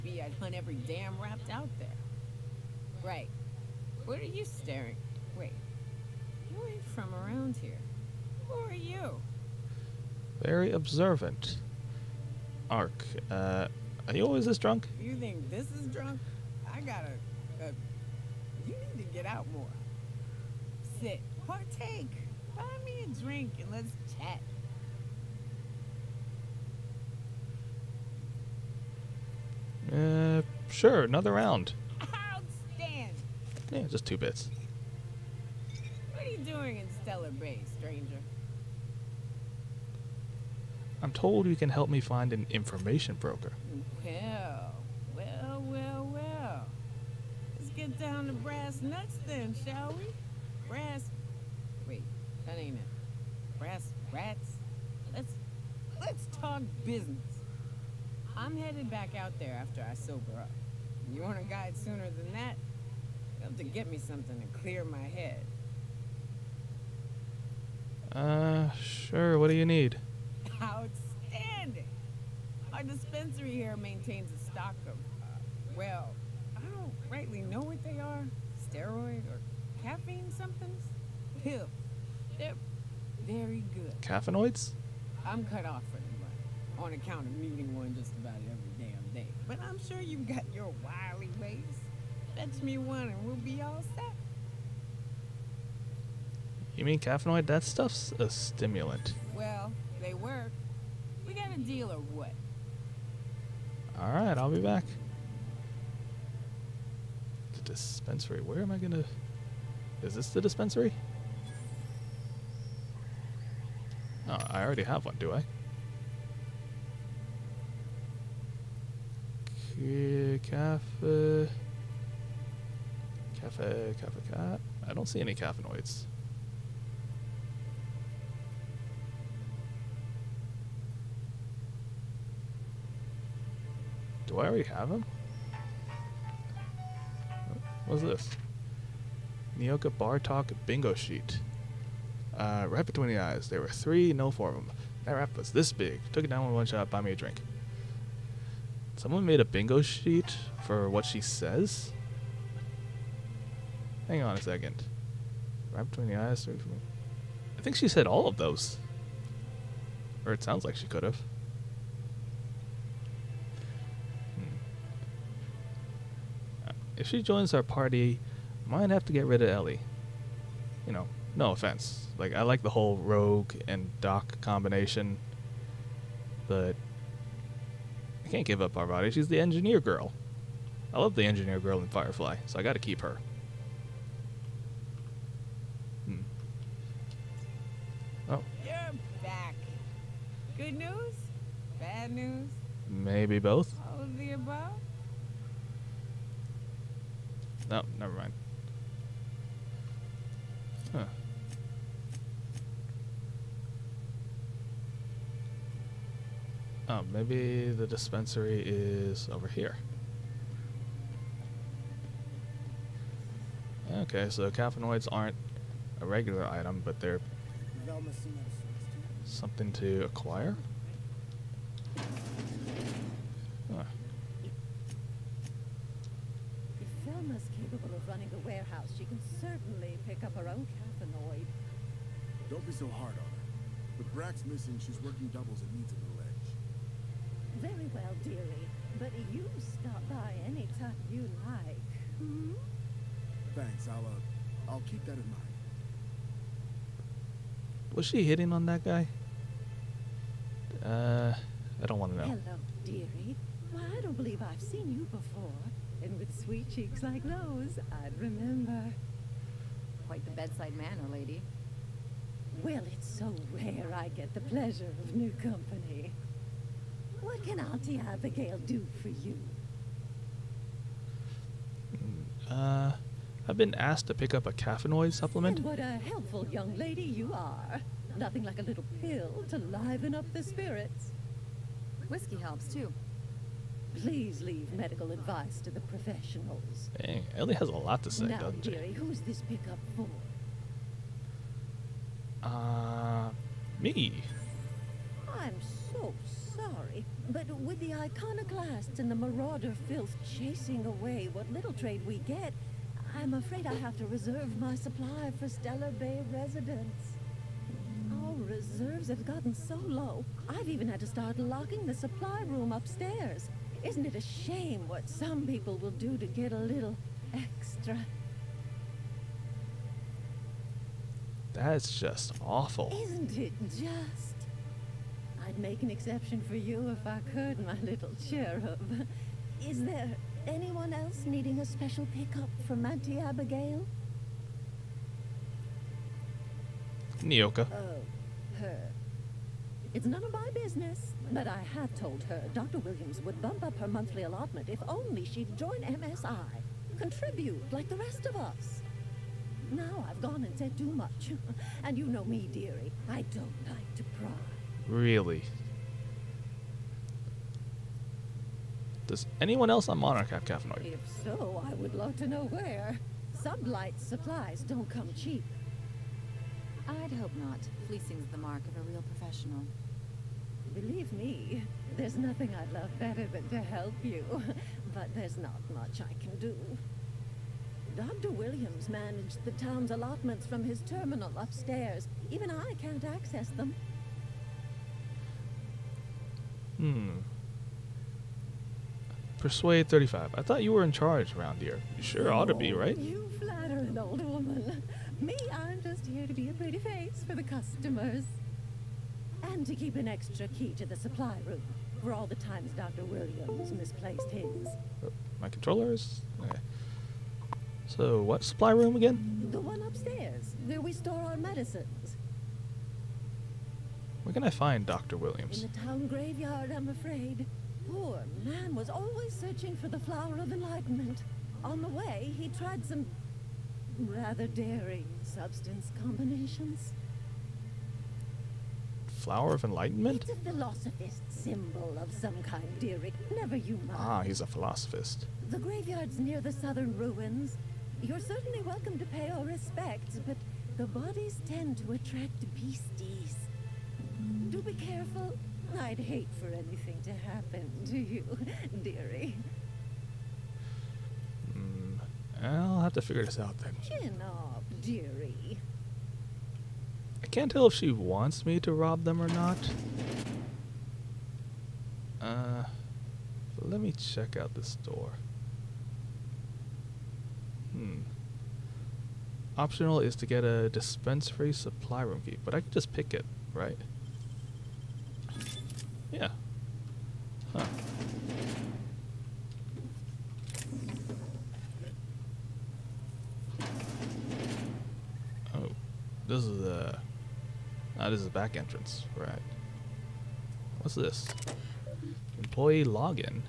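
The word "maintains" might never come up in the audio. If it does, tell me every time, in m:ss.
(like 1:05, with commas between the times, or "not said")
1:13.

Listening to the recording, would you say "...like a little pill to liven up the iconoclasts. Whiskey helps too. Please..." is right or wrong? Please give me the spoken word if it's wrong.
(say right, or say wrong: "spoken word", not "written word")
wrong: "spirits", not "iconoclasts".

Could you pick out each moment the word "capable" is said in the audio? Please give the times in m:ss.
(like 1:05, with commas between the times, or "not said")
3:47.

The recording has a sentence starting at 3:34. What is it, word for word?
Okay, so caffeinoids aren't a regular item, but they're something to acquire?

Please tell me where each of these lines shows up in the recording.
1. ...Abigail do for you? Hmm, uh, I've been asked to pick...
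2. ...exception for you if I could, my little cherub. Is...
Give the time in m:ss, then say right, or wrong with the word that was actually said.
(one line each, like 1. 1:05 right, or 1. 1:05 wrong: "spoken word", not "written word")
1. 4:28 right
2. 5:25 right.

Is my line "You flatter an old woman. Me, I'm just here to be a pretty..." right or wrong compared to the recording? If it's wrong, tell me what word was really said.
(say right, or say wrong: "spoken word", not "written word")
right.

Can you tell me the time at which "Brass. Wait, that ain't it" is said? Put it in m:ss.
0:50.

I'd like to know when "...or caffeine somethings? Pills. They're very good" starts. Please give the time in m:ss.
1:19.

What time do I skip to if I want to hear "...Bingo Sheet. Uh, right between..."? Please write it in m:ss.
2:20.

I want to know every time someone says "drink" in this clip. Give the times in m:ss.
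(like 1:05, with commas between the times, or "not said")
0:23, 2:27.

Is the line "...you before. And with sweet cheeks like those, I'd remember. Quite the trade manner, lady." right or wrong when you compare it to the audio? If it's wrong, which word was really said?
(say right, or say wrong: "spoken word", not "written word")
wrong: "bedside", not "trade".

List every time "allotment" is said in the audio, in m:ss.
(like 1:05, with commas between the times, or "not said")
5:44, 6:19.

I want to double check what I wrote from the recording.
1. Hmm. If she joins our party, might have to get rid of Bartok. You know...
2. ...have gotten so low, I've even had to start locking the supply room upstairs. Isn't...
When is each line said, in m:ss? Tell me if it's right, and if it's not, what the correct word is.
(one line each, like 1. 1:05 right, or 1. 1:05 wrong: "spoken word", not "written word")
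1. 2:44 wrong: "Ellie", not "Bartok"
2. 5:09 right.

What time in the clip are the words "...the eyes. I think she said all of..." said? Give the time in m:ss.
2:36.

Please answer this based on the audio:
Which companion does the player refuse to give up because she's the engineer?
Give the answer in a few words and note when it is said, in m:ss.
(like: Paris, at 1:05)
Parvati, at 2:58.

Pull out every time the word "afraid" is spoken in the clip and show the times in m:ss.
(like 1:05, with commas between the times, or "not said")
5:03, 6:56.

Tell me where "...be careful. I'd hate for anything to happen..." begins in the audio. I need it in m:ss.
7:24.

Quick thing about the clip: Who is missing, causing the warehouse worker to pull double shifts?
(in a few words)
Brax.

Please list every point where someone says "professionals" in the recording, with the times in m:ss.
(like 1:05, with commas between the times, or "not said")
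4:45, 6:09.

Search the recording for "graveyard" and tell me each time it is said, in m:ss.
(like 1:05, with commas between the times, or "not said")
6:56, 7:15.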